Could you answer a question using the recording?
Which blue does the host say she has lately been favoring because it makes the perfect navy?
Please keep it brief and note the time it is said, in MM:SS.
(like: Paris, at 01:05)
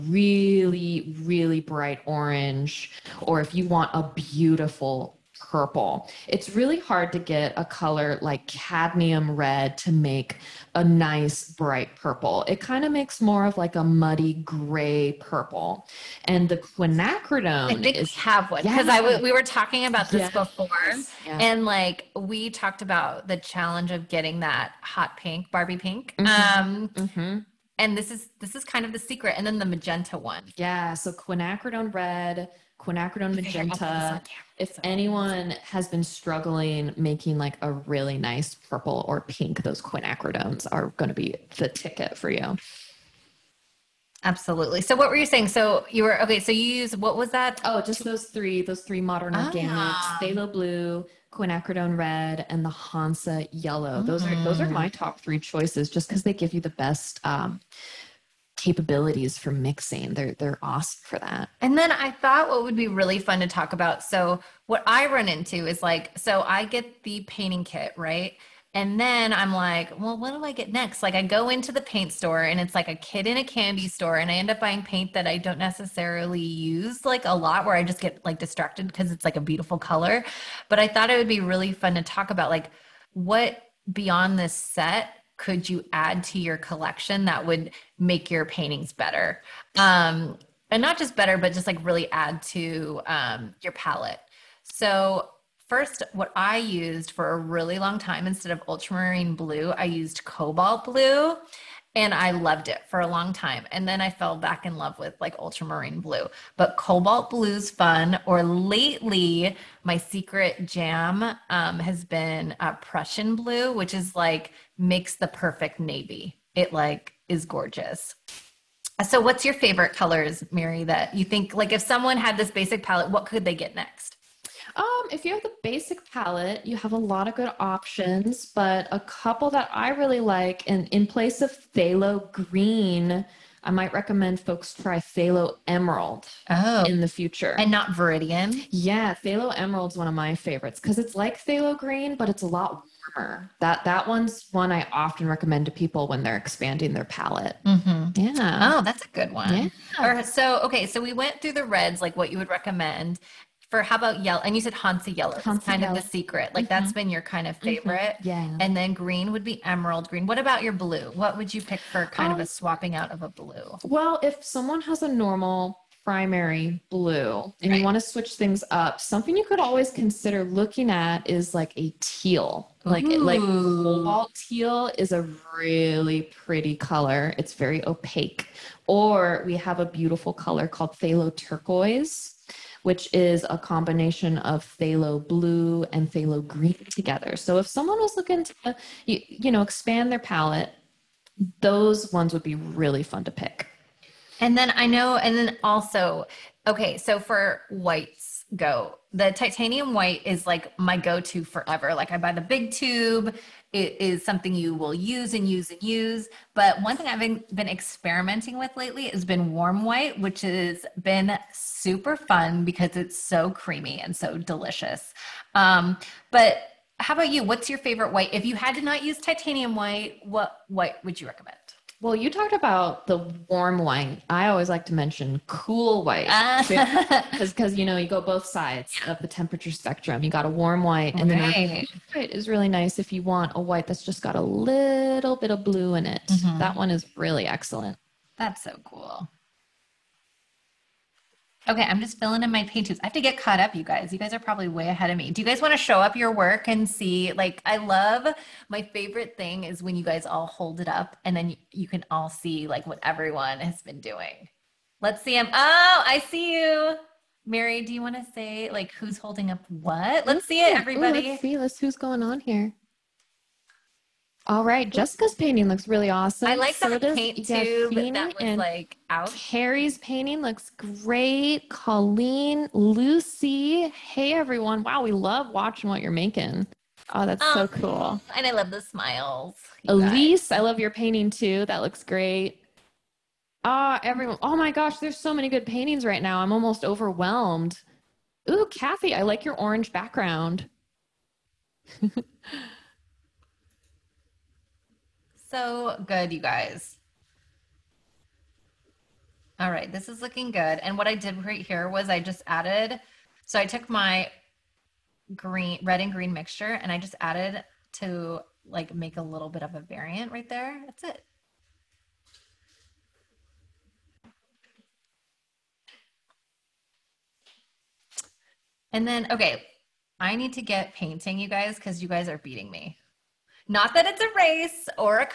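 Prussian blue, at 01:52.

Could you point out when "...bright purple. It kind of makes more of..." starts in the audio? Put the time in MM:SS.
00:11.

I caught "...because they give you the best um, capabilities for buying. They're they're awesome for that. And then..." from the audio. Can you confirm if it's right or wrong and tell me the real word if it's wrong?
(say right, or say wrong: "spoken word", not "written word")
wrong: "mixing", not "buying".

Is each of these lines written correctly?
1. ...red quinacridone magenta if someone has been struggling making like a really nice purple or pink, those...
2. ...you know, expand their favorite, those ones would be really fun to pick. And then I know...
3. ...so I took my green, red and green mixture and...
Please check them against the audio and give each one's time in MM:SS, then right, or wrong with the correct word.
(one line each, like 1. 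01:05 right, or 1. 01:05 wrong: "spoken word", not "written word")
1. 00:31 wrong: "anyone", not "someone"
2. 03:09 wrong: "palette", not "favorite"
3. 05:03 right.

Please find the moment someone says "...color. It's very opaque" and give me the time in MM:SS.
02:56.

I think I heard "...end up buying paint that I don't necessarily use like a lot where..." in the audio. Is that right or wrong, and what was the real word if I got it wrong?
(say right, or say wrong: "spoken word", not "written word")
right.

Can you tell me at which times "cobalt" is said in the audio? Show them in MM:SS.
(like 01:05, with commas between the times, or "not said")
01:40, 01:46.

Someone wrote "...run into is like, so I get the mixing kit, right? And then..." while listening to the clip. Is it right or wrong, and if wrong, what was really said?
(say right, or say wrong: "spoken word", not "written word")
wrong: "painting", not "mixing".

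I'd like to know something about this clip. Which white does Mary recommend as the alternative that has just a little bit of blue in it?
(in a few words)
cool white.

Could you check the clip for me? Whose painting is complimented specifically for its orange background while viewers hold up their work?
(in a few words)
Kathy.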